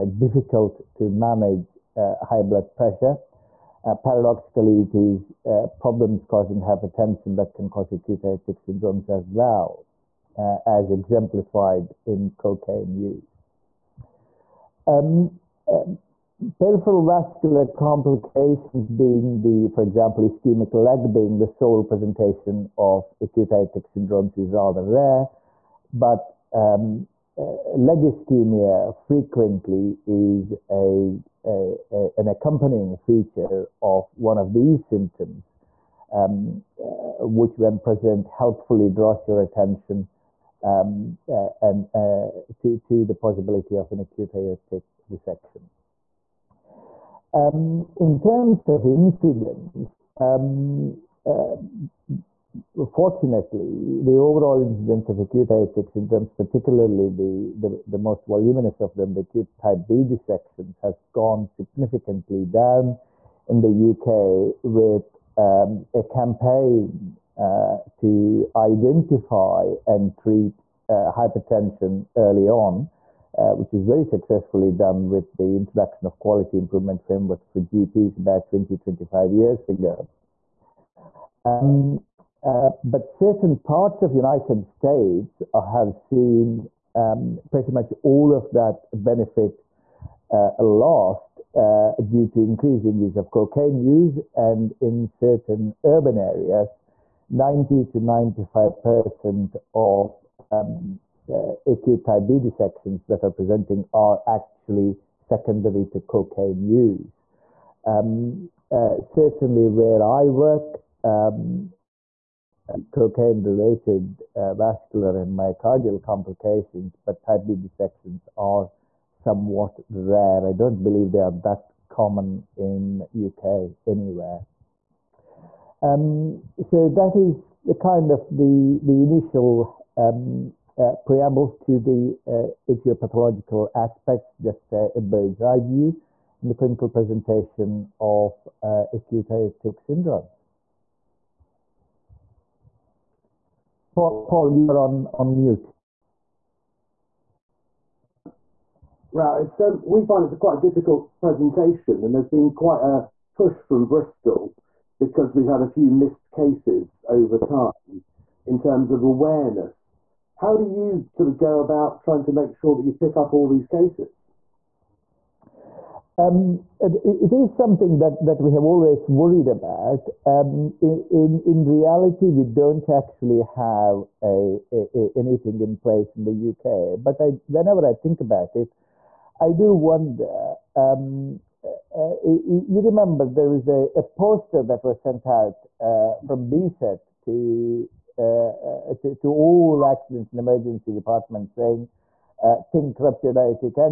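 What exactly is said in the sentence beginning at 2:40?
How do you sort of go about trying to make sure that you pick up all these cases?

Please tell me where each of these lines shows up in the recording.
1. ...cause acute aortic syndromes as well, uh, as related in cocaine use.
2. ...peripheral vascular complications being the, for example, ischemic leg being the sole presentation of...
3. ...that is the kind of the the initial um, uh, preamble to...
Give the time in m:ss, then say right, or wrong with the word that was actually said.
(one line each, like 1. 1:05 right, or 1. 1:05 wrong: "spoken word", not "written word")
1. 0:07 wrong: "exemplified", not "related"
2. 0:16 right
3. 2:06 right.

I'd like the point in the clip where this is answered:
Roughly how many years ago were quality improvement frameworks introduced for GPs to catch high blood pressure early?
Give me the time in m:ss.
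1:18.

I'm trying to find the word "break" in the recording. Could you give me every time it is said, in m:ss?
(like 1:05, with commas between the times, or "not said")
not said.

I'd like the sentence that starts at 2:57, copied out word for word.
But I, whenever I think about it, I do wonder.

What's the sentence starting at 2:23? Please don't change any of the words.
Paul, Paul you're on, on mute.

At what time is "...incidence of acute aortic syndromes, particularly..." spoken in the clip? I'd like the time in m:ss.
0:54.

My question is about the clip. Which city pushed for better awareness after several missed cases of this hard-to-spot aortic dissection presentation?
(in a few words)
Bristol.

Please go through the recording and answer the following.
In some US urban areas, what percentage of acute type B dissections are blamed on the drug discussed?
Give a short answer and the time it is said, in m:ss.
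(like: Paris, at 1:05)
90 to 95 percent, at 1:37.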